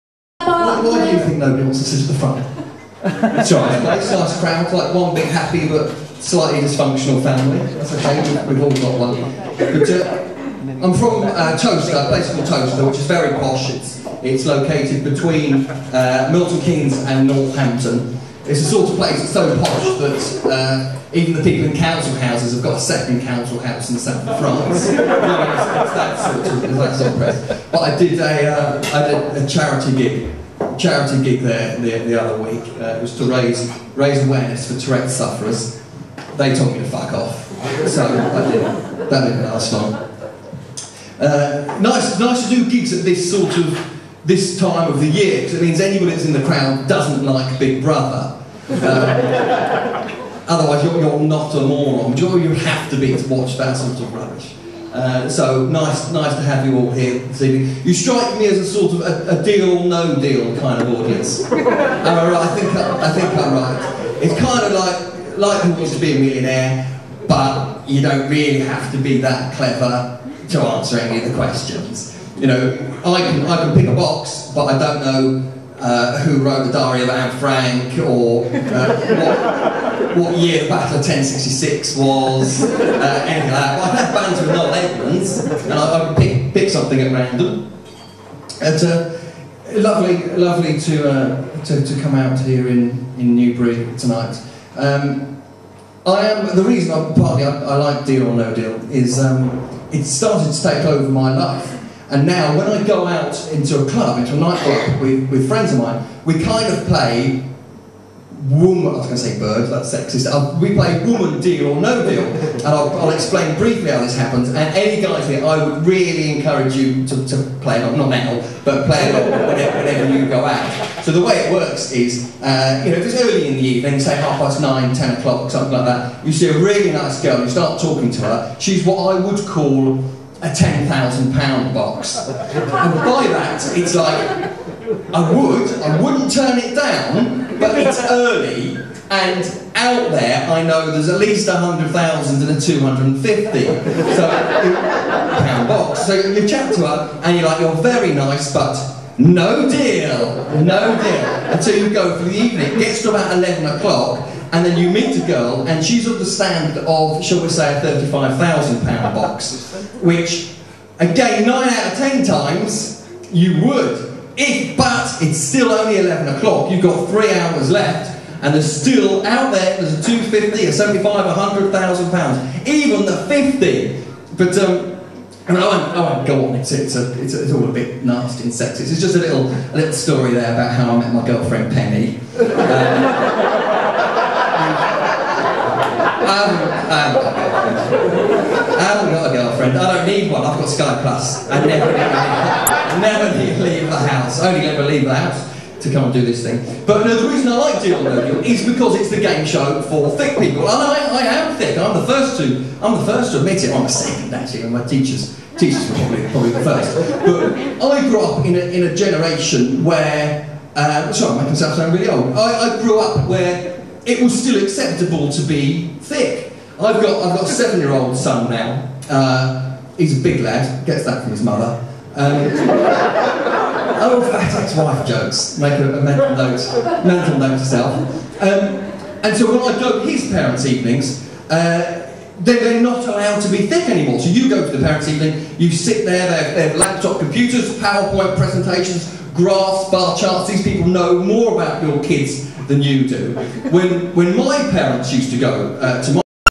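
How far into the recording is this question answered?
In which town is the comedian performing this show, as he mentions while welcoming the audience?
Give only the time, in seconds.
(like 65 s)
93 s.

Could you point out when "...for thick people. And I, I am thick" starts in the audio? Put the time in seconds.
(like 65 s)
199 s.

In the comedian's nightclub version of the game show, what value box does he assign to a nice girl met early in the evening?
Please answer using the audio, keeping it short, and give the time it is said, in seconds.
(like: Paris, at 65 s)
£10,000, at 130 s.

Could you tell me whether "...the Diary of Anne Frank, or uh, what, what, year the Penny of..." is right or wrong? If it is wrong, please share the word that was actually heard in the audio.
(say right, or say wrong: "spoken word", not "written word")
wrong: "Battle", not "Penny".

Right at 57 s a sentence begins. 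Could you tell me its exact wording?
You strike me as a sort of a, a deal, no deal kind of audience.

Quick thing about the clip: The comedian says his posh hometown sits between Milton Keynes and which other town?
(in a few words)
Northampton.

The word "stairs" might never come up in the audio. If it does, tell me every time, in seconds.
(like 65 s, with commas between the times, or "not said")
not said.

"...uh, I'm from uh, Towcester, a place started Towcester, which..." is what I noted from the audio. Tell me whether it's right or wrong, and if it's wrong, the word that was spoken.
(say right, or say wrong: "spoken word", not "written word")
wrong: "called", not "started".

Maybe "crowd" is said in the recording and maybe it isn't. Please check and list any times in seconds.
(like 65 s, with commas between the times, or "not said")
4 s, 46 s.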